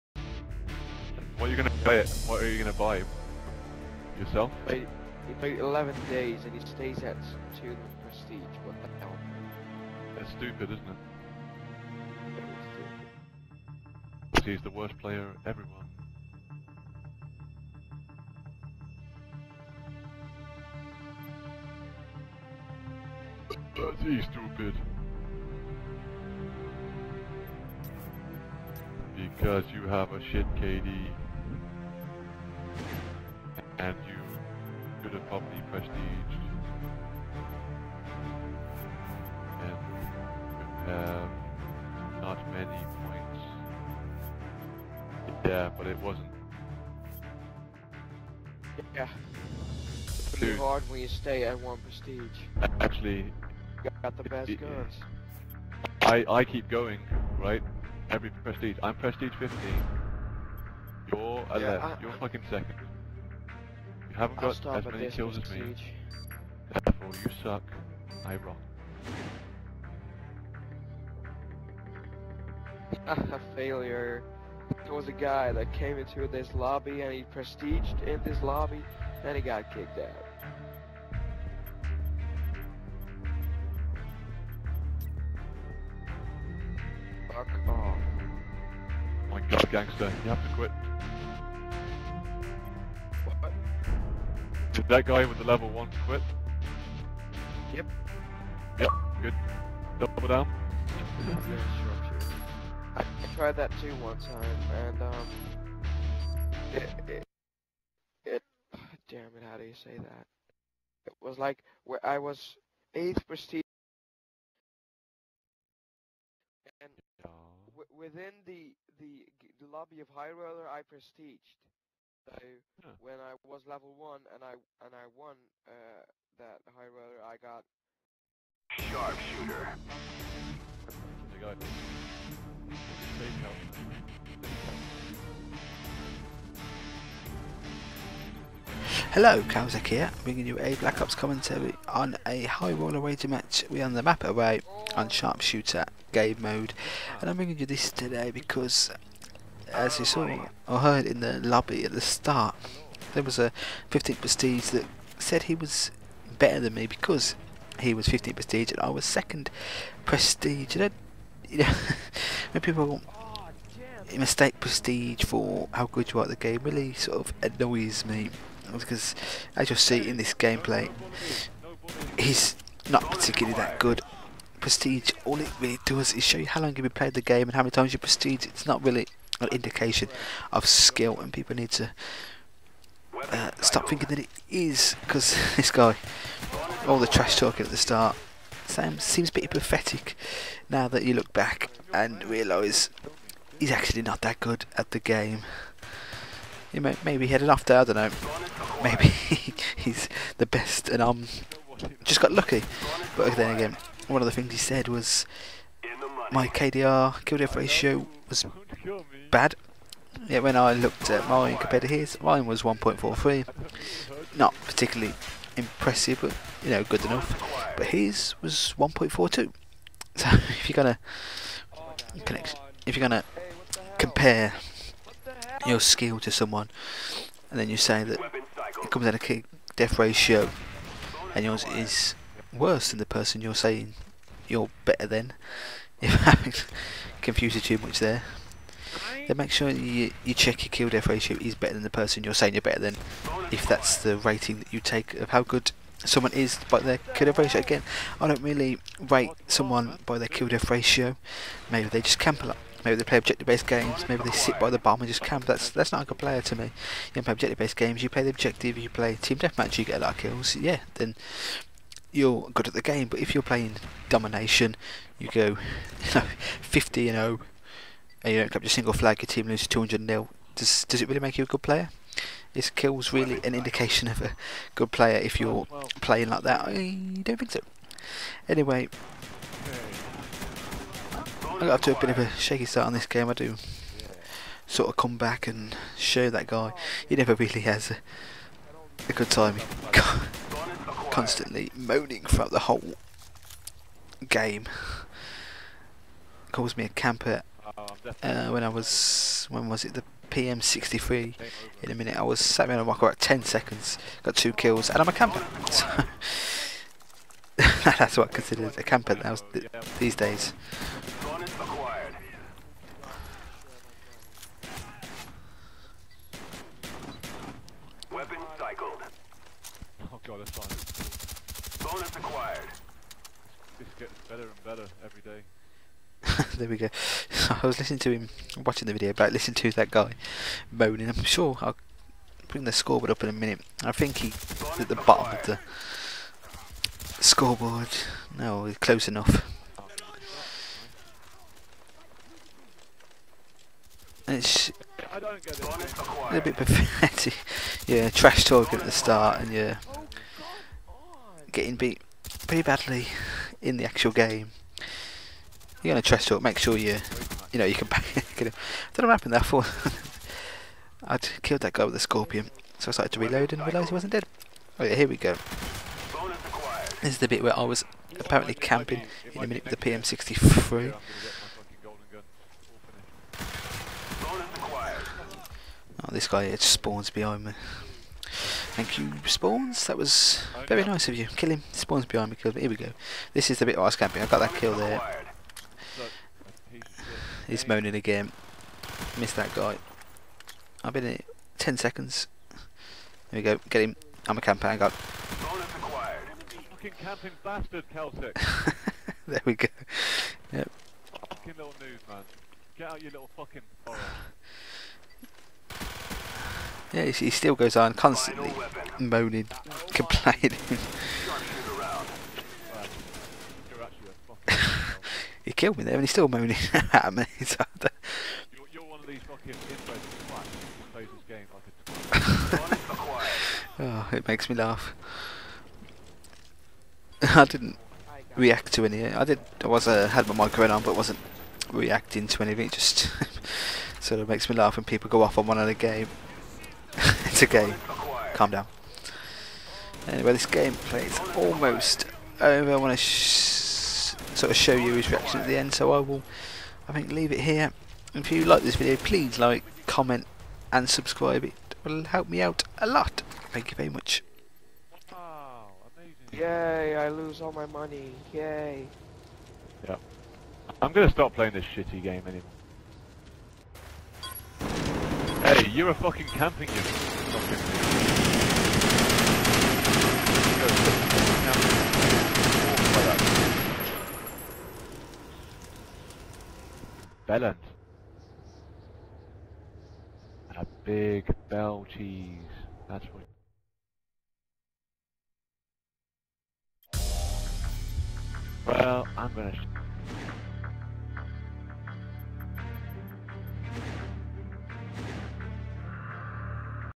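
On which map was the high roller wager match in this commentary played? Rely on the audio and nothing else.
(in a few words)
Array.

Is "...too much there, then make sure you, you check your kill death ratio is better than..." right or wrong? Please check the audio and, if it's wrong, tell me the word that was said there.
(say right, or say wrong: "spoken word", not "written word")
right.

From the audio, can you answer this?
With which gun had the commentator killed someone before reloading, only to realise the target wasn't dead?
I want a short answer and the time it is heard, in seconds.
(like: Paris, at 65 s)
Scorpion, at 361 s.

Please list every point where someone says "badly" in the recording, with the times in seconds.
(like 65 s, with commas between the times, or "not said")
352 s.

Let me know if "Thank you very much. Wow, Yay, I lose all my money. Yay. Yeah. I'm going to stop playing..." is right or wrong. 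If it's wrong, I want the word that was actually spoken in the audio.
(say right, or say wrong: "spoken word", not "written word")
right.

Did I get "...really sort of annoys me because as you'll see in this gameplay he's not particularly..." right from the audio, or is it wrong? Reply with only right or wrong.
right.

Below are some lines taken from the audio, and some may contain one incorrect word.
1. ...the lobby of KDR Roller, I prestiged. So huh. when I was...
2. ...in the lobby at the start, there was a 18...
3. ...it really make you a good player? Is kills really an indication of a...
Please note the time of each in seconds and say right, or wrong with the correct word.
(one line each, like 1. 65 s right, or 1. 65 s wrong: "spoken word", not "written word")
1. 119 s wrong: "High", not "KDR"
2. 151 s wrong: "15", not "18"
3. 271 s right.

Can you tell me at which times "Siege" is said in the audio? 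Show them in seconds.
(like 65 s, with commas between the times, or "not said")
65 s.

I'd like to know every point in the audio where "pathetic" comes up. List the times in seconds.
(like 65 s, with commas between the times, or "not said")
189 s, 346 s.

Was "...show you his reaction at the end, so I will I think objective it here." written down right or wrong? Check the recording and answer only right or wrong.
wrong.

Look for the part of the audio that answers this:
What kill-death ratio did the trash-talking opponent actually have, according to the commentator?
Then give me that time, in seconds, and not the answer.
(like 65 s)
218 s.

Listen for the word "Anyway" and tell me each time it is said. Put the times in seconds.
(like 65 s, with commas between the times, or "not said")
278 s, 440 s.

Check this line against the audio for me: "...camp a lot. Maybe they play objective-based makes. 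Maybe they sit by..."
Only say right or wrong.
wrong.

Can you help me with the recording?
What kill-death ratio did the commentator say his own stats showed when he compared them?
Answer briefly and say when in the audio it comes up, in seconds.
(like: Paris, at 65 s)
1.43, at 212 s.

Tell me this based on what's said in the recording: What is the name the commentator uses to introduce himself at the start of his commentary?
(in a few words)
Kalzec.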